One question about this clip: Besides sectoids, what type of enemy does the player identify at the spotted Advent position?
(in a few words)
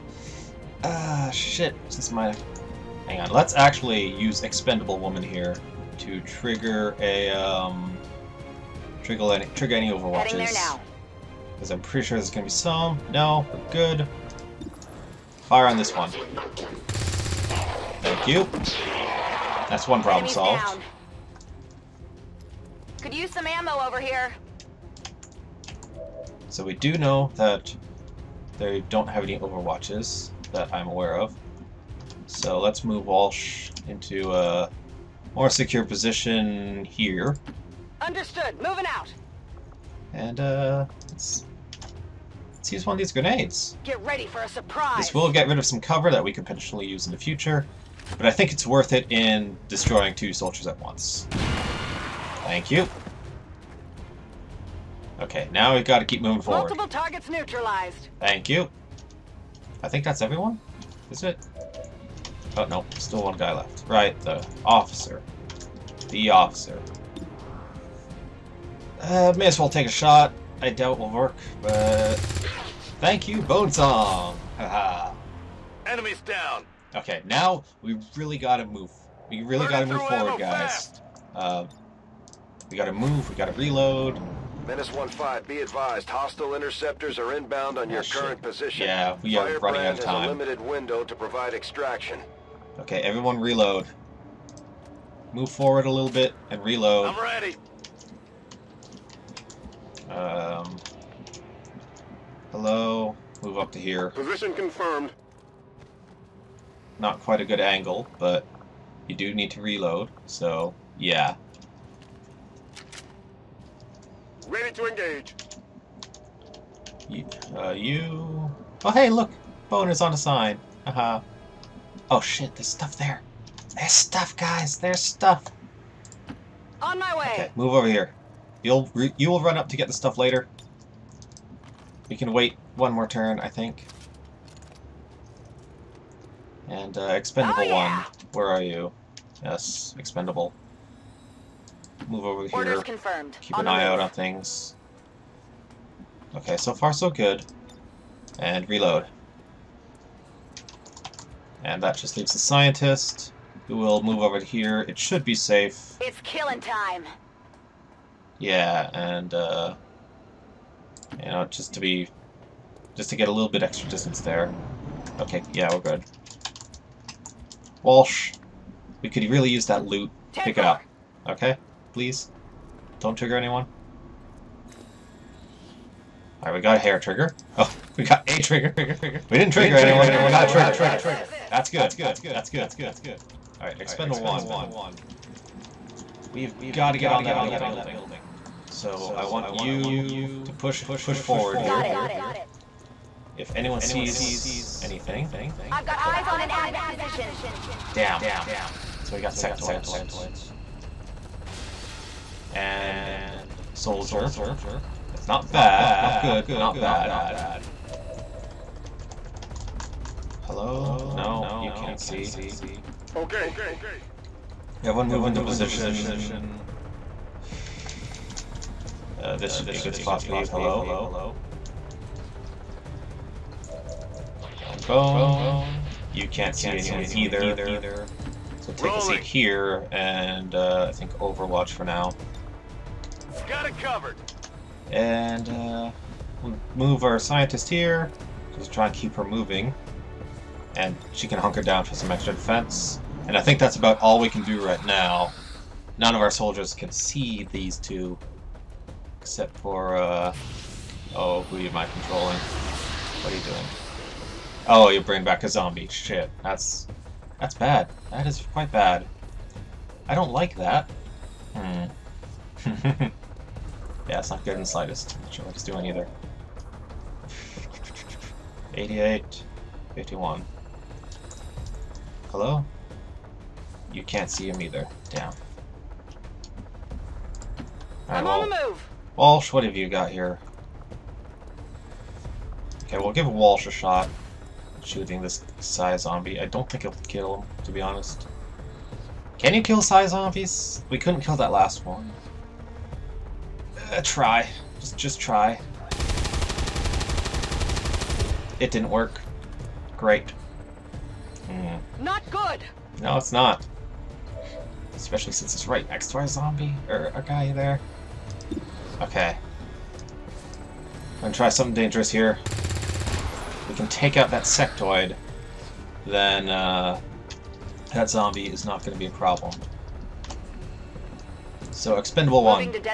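soldier.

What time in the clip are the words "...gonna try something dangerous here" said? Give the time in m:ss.
5:11.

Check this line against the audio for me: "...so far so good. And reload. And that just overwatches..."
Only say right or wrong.
wrong.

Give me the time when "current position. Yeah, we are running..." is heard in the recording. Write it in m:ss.
1:28.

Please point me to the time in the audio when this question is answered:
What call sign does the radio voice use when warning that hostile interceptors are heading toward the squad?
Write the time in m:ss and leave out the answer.
1:24.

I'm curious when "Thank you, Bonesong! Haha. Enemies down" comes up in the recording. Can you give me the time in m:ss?
1:12.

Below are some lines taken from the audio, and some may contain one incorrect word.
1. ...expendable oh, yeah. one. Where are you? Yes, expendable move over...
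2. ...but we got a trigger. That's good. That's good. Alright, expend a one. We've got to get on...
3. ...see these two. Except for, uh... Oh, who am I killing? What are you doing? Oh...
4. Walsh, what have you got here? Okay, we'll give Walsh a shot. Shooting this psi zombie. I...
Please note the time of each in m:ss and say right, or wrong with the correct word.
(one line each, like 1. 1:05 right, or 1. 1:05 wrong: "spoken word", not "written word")
1. 2:17 right
2. 3:00 right
3. 4:06 wrong: "controlling", not "killing"
4. 4:39 right.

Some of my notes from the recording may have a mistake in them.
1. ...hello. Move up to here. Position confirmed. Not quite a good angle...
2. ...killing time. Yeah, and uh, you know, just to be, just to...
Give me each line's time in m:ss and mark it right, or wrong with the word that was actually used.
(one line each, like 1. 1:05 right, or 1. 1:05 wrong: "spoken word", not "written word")
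1. 1:42 right
2. 2:36 right.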